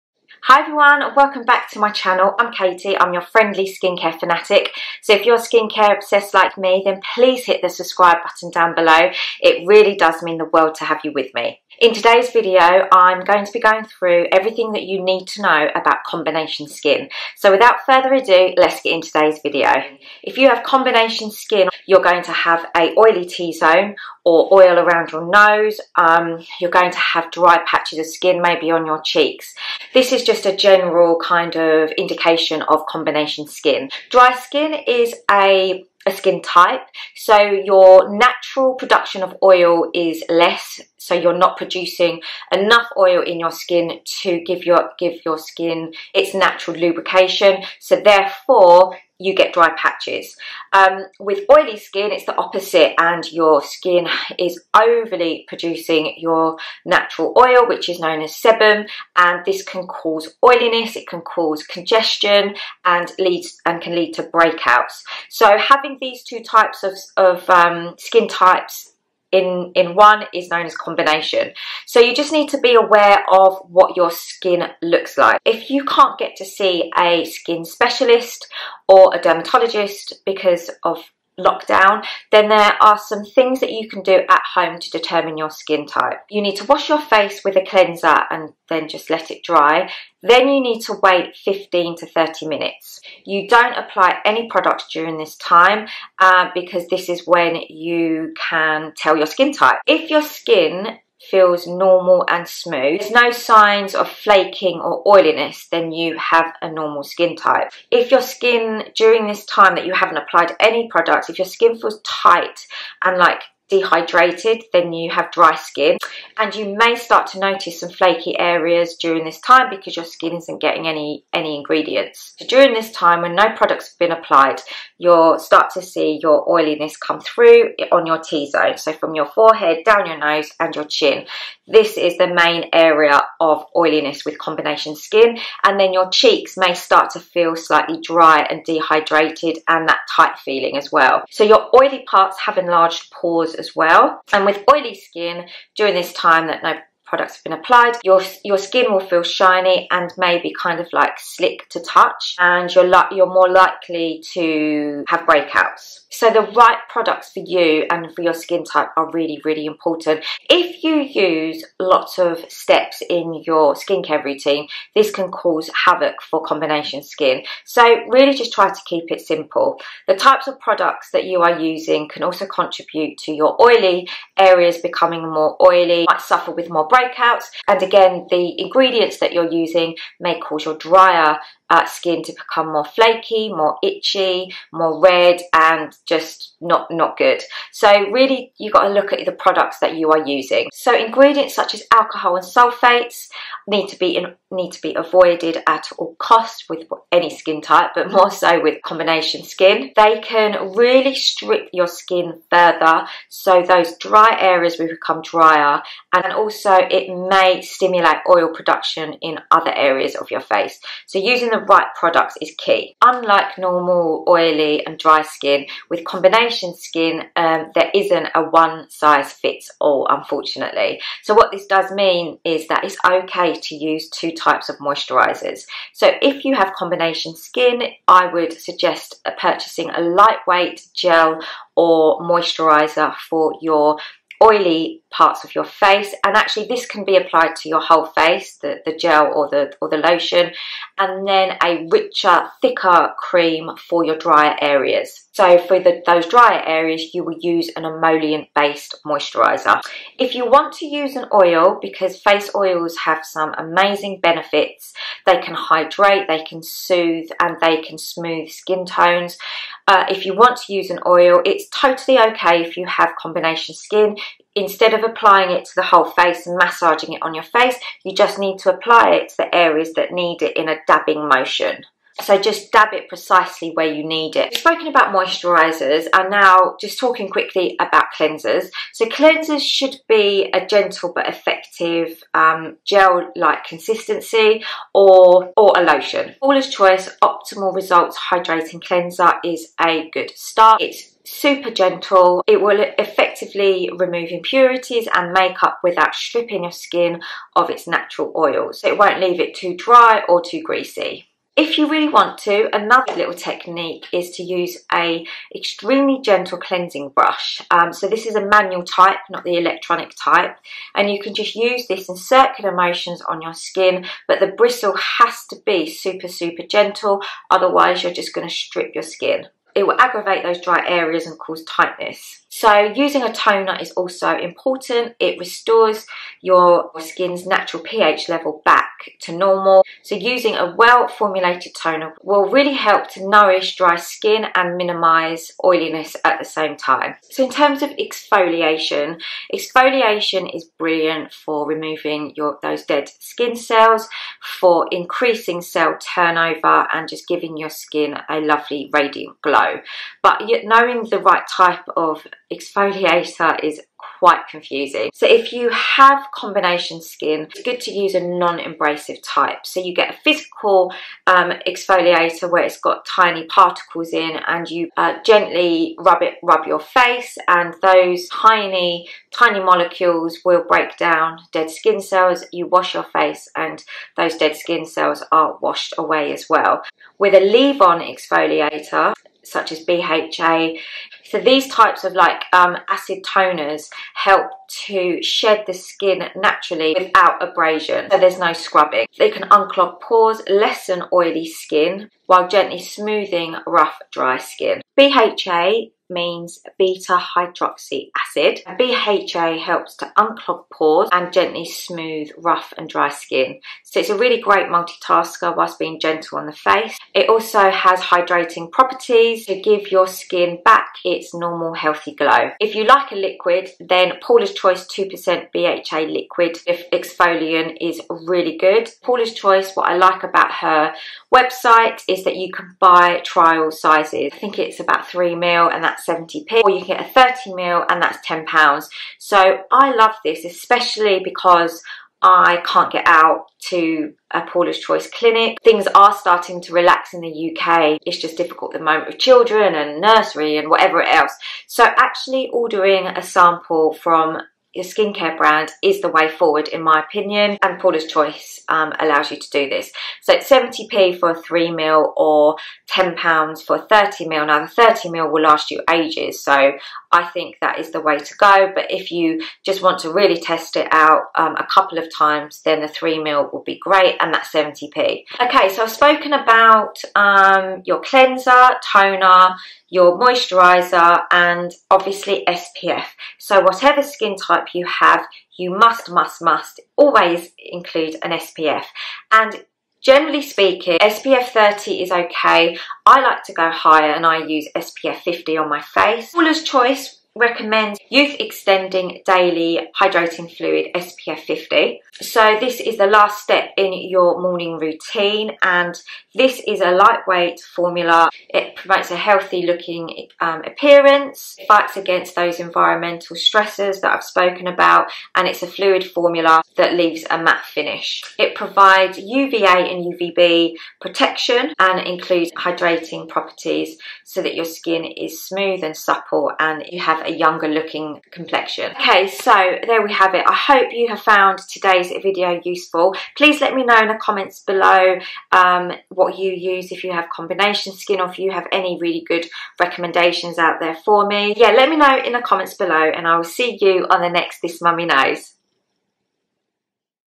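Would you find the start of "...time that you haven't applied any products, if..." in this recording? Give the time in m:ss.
1:49.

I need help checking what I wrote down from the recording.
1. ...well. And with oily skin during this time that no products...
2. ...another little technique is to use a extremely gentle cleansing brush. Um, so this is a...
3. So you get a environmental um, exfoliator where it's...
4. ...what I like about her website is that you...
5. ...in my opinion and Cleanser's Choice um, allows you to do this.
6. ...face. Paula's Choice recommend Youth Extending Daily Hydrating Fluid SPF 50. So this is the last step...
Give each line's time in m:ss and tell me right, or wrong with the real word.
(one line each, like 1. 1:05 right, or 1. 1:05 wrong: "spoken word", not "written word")
1. 2:23 right
2. 5:02 right
3. 5:59 wrong: "physical", not "environmental"
4. 6:59 right
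5. 7:26 wrong: "Paula", not "Cleanser"
6. 8:05 right.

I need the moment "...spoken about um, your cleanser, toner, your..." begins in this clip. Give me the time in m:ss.
7:45.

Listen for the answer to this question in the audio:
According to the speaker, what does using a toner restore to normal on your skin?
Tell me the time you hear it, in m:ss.
5:27.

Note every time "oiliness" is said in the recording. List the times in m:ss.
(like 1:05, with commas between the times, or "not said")
1:00, 1:45, 2:06, 2:13, 5:35.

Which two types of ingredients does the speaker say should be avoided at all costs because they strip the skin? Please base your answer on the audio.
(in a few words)
alcohol and sulfates.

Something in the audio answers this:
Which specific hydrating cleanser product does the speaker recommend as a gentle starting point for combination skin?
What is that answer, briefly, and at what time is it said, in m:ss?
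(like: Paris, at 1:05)
Optimal Results Hydrating Cleanser, at 4:47.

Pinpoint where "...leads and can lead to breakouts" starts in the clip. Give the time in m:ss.
1:03.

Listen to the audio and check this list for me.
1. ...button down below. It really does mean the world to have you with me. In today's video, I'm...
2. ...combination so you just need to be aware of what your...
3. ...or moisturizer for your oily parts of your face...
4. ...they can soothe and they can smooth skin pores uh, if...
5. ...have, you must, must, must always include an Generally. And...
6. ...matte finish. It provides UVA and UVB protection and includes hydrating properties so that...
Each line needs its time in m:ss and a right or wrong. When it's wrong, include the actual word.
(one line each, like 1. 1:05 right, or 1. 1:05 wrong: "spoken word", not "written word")
1. 0:08 right
2. 1:10 right
3. 3:51 right
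4. 4:16 wrong: "tones", not "pores"
5. 7:54 wrong: "SPF", not "Generally"
6. 8:27 right.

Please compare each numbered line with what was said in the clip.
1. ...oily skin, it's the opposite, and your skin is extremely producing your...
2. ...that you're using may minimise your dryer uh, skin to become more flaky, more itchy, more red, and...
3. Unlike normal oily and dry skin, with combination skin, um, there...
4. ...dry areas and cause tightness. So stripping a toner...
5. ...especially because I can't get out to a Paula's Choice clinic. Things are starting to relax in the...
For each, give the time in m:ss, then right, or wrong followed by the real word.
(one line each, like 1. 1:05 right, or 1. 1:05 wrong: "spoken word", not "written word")
1. 0:51 wrong: "overly", not "extremely"
2. 2:59 wrong: "cause", not "minimise"
3. 3:33 right
4. 5:20 wrong: "using", not "stripping"
5. 7:10 right.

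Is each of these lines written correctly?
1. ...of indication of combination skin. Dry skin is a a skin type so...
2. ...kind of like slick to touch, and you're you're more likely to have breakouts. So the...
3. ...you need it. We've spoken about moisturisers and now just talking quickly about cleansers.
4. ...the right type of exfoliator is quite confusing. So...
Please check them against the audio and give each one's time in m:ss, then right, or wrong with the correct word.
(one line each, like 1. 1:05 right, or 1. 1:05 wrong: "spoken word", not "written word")
1. 0:31 right
2. 2:30 right
3. 4:33 right
4. 5:51 right.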